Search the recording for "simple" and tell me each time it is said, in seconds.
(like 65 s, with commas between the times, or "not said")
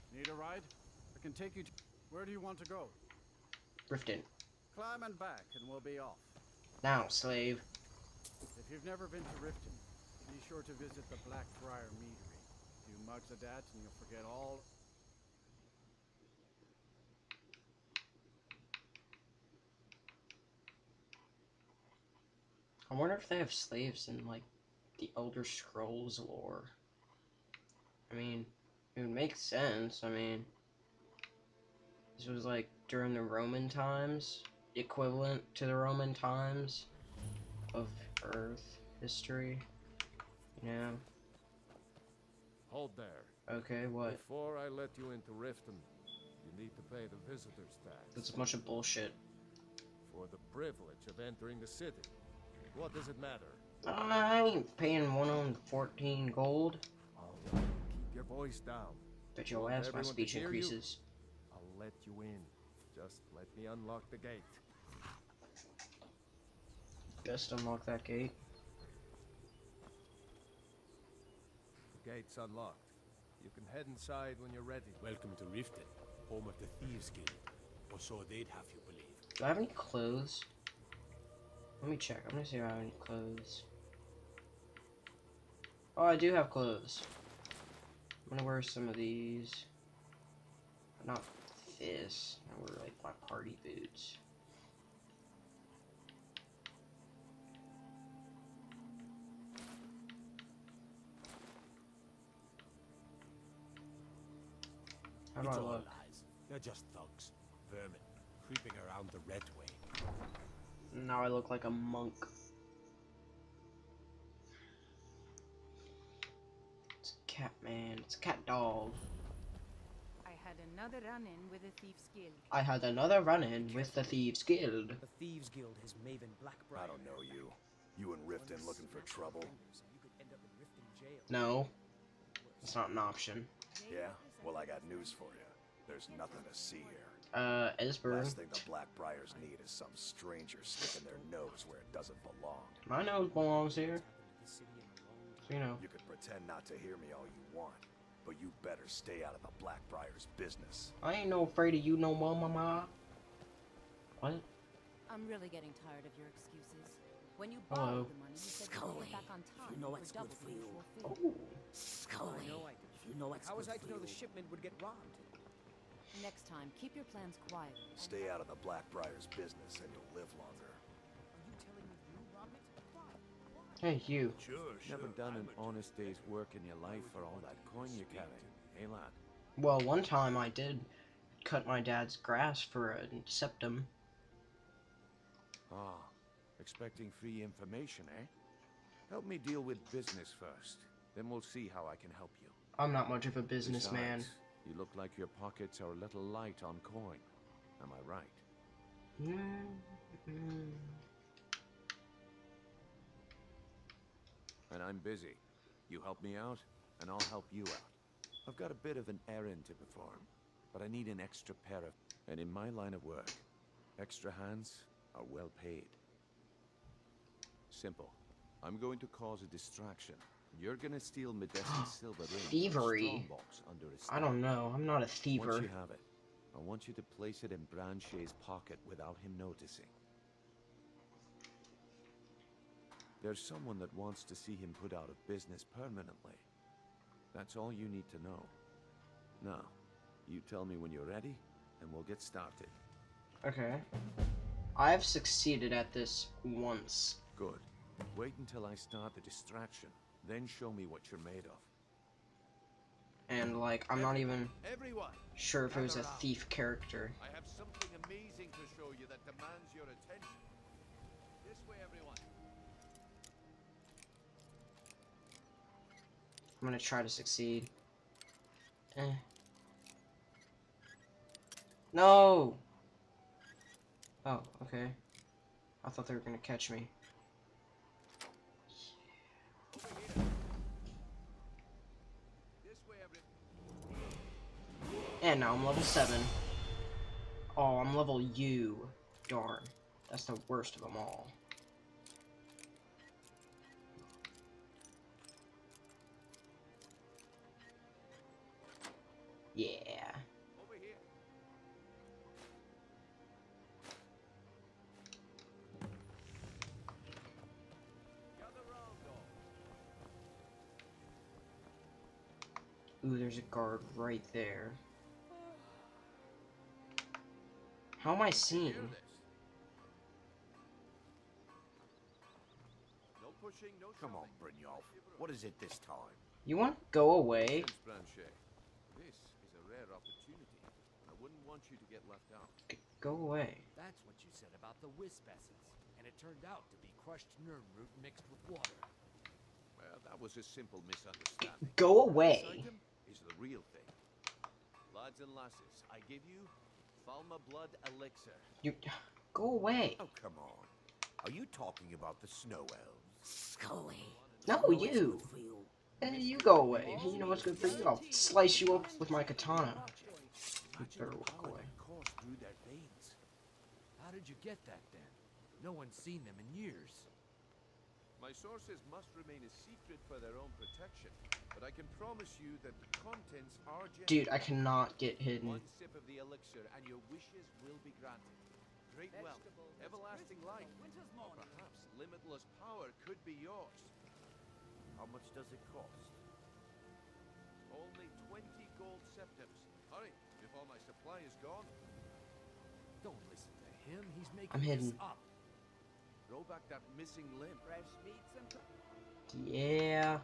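217 s, 340 s.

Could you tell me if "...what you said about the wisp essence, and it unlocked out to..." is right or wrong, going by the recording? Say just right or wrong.
wrong.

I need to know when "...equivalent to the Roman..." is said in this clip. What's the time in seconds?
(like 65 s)
34 s.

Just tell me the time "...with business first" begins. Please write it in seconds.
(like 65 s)
189 s.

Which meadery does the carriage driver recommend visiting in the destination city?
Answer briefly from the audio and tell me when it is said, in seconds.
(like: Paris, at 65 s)
Blackbriar Meadery, at 11 s.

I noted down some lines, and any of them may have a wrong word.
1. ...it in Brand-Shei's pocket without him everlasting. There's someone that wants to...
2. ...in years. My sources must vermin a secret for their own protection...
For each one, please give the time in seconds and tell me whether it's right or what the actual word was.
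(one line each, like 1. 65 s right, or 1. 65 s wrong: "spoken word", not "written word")
1. 227 s wrong: "noticing", not "everlasting"
2. 366 s wrong: "remain", not "vermin".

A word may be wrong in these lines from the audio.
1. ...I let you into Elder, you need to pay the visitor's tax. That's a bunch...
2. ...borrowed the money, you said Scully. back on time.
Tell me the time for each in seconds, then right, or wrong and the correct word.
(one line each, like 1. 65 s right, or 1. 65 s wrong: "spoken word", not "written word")
1. 44 s wrong: "Riften", not "Elder"
2. 157 s right.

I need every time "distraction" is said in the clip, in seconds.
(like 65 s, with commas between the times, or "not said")
219 s, 249 s.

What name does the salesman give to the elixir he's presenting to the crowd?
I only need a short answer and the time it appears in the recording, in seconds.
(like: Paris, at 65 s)
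Falmer blood elixir, at 347 s.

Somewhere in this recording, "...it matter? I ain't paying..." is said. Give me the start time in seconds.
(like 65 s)
53 s.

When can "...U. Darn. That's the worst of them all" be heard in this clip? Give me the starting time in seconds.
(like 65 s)
288 s.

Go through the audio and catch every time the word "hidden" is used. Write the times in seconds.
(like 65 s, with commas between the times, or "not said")
375 s, 394 s.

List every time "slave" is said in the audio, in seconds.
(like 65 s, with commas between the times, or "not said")
7 s, 23 s.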